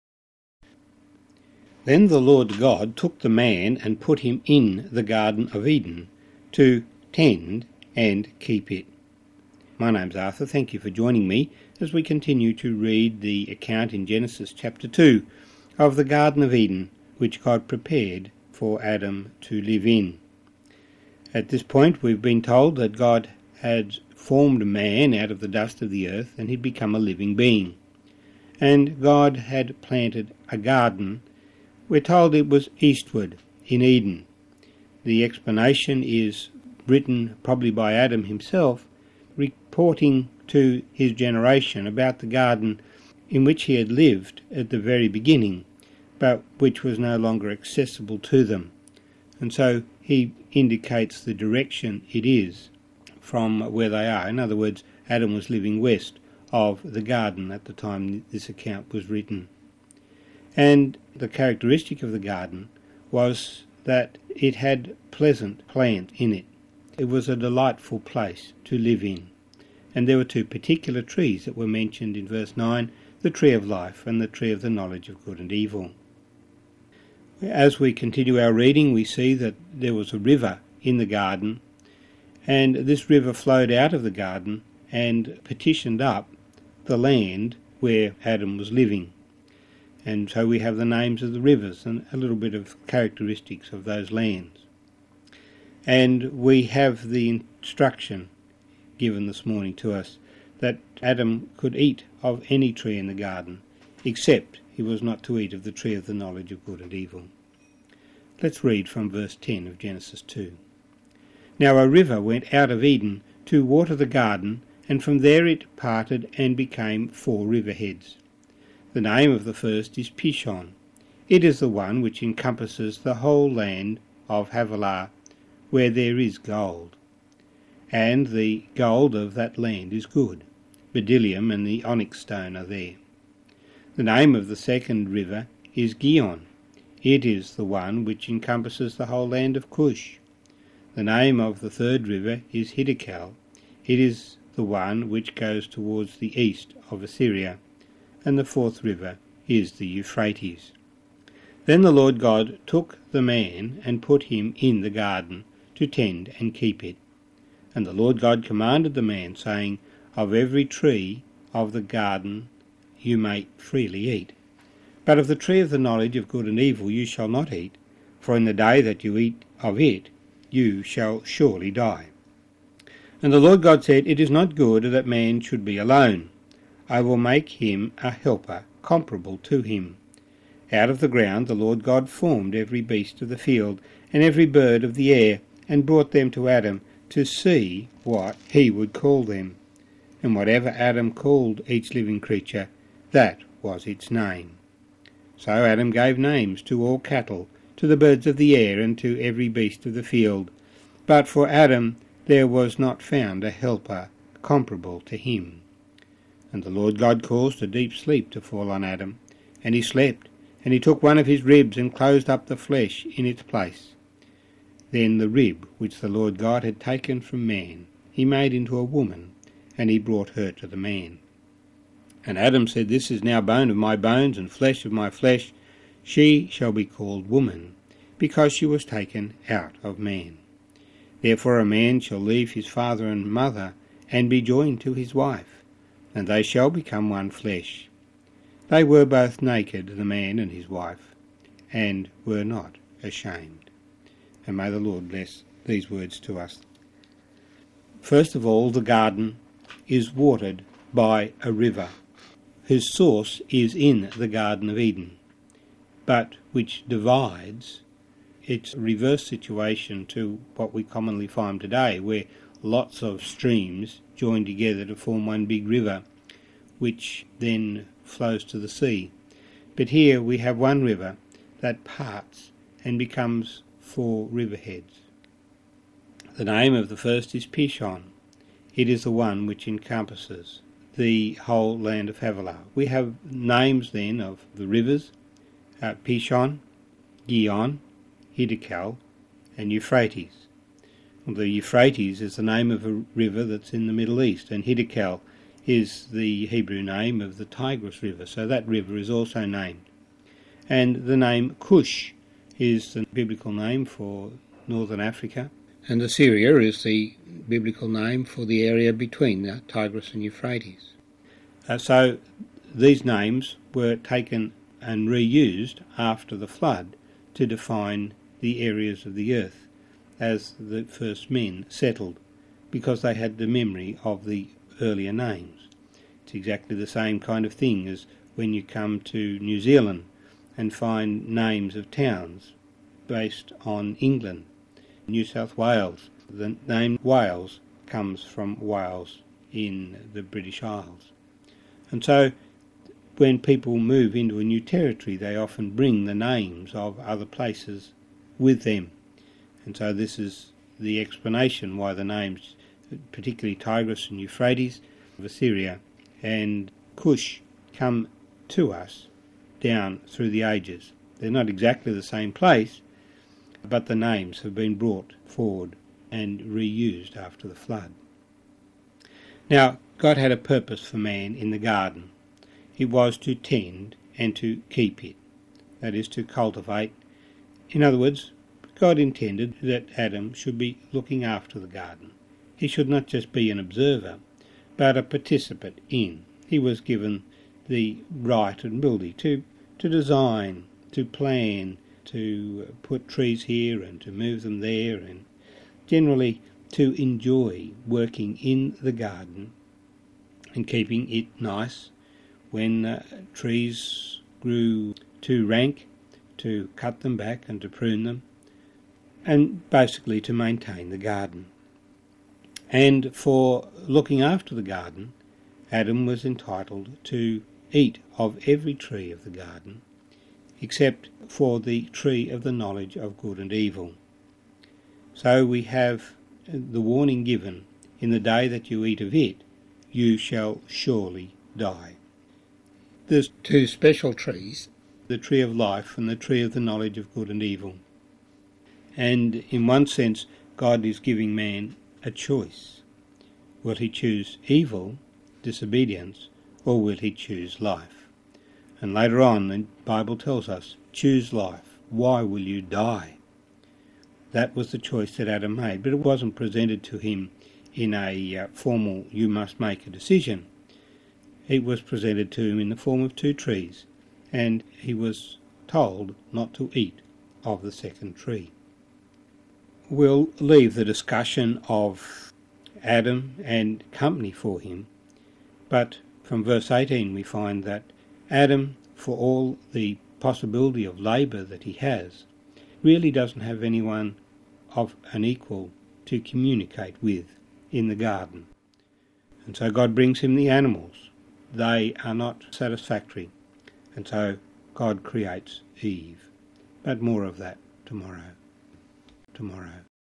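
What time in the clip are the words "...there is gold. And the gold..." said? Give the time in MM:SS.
02:05.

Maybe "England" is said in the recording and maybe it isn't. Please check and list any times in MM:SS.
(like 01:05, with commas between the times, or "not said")
05:33.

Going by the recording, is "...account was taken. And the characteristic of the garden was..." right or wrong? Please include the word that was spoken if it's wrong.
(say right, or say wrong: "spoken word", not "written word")
wrong: "written", not "taken".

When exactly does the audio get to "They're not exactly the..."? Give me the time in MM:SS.
06:01.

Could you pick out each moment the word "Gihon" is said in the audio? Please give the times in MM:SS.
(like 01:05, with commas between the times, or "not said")
02:15, 04:47.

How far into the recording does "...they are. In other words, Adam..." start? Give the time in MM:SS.
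00:53.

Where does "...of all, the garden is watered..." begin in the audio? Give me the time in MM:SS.
04:08.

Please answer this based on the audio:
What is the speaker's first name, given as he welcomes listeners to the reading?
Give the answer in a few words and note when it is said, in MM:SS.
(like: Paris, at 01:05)
Arthur, at 00:10.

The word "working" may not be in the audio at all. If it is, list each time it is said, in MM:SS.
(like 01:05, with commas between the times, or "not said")
06:37.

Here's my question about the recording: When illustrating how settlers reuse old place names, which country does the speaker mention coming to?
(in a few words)
New Zealand.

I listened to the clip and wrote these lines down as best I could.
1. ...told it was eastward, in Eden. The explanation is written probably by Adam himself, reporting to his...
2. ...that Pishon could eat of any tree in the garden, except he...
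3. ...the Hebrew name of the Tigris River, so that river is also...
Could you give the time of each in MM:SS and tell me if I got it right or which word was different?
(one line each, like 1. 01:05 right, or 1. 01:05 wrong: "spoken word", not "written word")
1. 00:31 right
2. 01:40 wrong: "Adam", not "Pishon"
3. 04:56 right.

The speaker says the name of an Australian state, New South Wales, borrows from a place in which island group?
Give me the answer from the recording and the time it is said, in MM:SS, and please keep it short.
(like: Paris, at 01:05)
British Isles, at 05:40.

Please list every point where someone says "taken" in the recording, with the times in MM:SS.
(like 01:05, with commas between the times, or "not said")
03:36, 03:48, 05:13.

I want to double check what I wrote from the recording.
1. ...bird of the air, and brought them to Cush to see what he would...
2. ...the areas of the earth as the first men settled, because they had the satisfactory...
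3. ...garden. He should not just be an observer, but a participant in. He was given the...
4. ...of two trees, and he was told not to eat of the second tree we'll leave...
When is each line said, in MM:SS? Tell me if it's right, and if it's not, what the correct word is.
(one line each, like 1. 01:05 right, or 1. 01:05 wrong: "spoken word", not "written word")
1. 03:04 wrong: "Adam", not "Cush"
2. 05:18 wrong: "memory", not "satisfactory"
3. 06:21 right
4. 07:43 right.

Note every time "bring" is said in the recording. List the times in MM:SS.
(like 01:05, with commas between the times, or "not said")
05:45, 08:09.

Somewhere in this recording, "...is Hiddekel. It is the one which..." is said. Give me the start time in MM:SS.
02:22.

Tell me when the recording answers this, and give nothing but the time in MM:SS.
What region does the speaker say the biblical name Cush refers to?
05:04.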